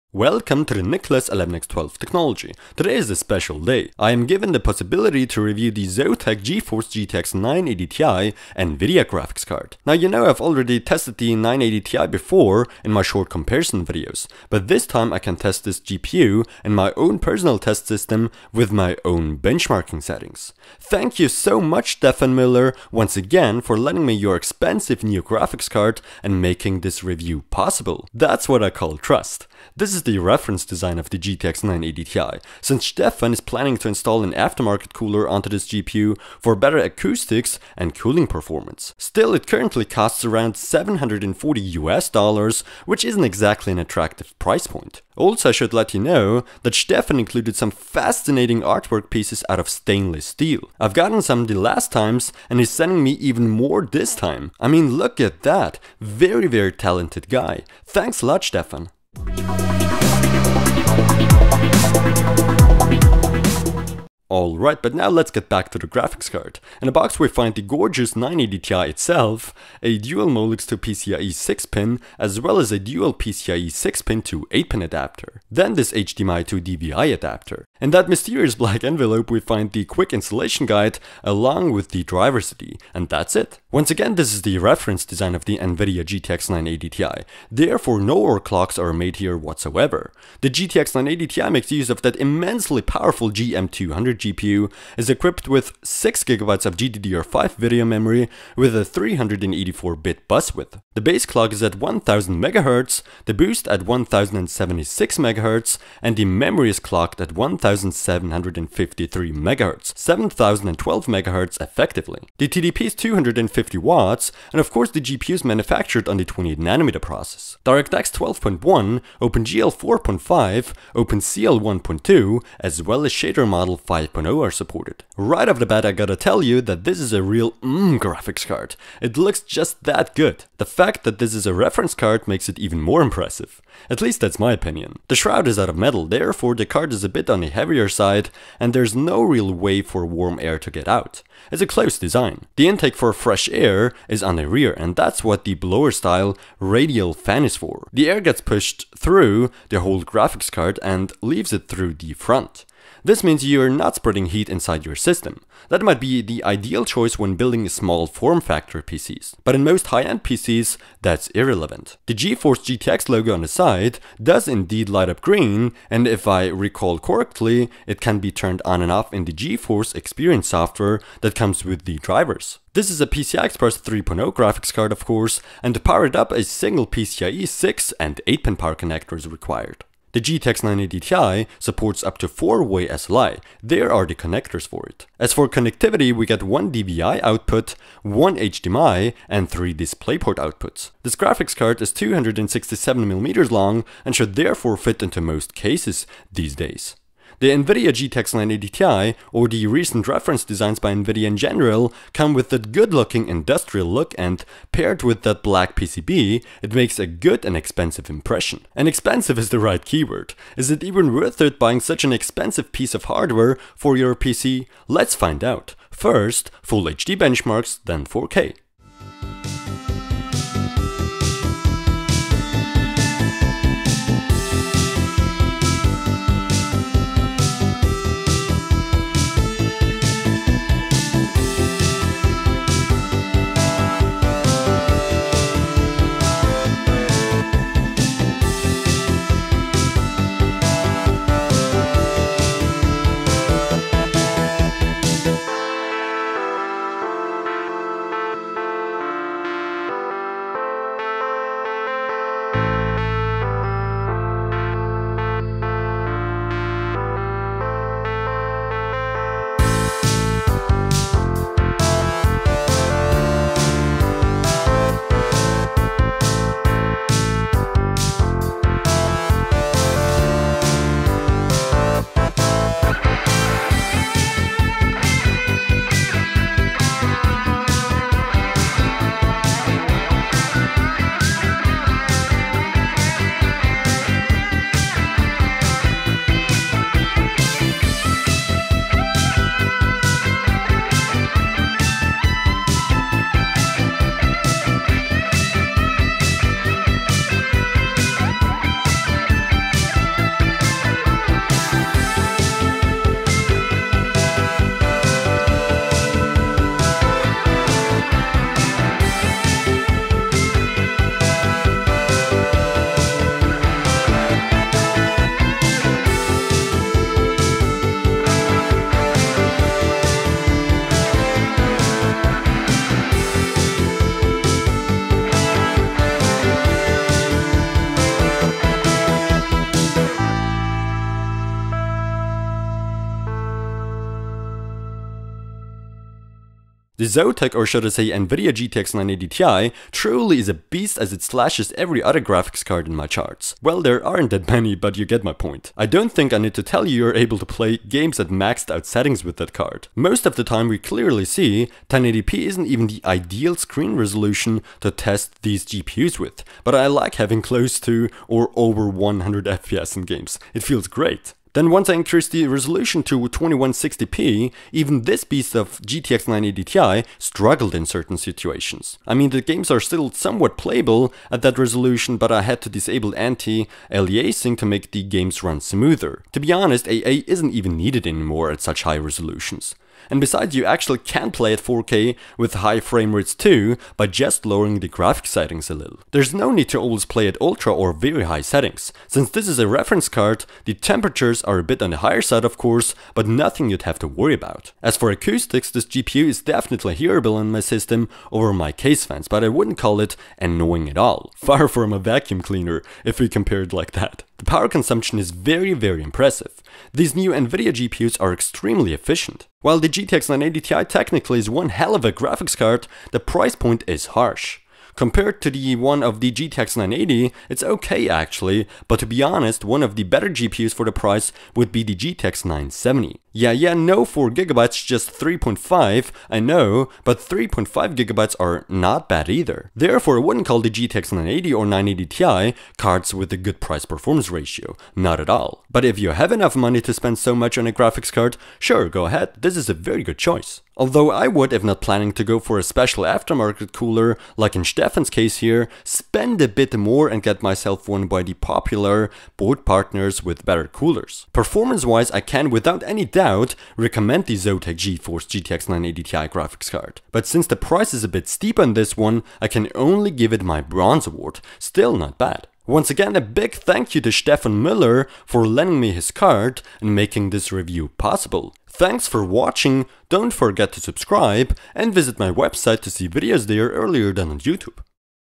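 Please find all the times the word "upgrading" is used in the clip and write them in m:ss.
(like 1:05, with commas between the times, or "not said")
not said.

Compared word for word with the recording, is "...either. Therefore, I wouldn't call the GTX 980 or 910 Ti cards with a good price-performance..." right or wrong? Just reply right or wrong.
wrong.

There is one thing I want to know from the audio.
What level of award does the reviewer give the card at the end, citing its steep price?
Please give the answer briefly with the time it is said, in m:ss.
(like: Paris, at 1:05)
bronze, at 7:40.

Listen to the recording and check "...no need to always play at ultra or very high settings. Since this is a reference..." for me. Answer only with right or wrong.
right.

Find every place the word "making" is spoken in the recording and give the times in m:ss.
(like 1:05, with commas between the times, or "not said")
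0:26, 7:46.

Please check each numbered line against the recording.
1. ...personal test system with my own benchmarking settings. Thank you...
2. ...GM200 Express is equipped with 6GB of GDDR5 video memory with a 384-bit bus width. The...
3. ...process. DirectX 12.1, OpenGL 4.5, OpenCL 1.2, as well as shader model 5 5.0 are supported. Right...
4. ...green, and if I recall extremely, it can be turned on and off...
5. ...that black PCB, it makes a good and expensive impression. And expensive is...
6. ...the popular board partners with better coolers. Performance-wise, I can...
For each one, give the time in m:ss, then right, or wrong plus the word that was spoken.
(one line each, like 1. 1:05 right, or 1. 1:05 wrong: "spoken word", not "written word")
1. 0:17 right
2. 1:33 wrong: "GPU", not "Express"
3. 1:57 right
4. 2:45 wrong: "correctly", not "extremely"
5. 3:25 right
6. 7:28 right.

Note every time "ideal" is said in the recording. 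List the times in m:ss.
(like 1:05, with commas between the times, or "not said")
2:36, 5:53.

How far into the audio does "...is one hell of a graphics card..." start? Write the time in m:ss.
6:51.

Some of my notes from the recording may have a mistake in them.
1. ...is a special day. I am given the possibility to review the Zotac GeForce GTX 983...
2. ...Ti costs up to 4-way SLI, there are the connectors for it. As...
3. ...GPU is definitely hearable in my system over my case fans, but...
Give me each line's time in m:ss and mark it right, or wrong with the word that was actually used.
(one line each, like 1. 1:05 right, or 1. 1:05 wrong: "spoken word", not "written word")
1. 0:02 wrong: "980", not "983"
2. 3:00 wrong: "supports", not "costs"
3. 6:35 right.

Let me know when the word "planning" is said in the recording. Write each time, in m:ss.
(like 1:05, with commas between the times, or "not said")
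0:33, 7:21.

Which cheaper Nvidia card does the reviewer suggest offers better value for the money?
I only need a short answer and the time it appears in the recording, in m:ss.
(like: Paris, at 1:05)
GTX 970, at 7:01.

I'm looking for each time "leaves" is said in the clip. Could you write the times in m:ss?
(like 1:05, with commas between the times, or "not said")
2:31.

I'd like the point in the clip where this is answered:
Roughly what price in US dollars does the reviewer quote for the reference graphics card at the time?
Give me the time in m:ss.
0:40.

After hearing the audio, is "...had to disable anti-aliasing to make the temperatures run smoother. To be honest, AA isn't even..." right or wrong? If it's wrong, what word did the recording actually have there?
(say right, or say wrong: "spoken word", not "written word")
wrong: "games", not "temperatures".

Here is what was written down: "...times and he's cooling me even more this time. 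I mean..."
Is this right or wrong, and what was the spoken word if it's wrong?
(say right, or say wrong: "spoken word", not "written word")
wrong: "sending", not "cooling".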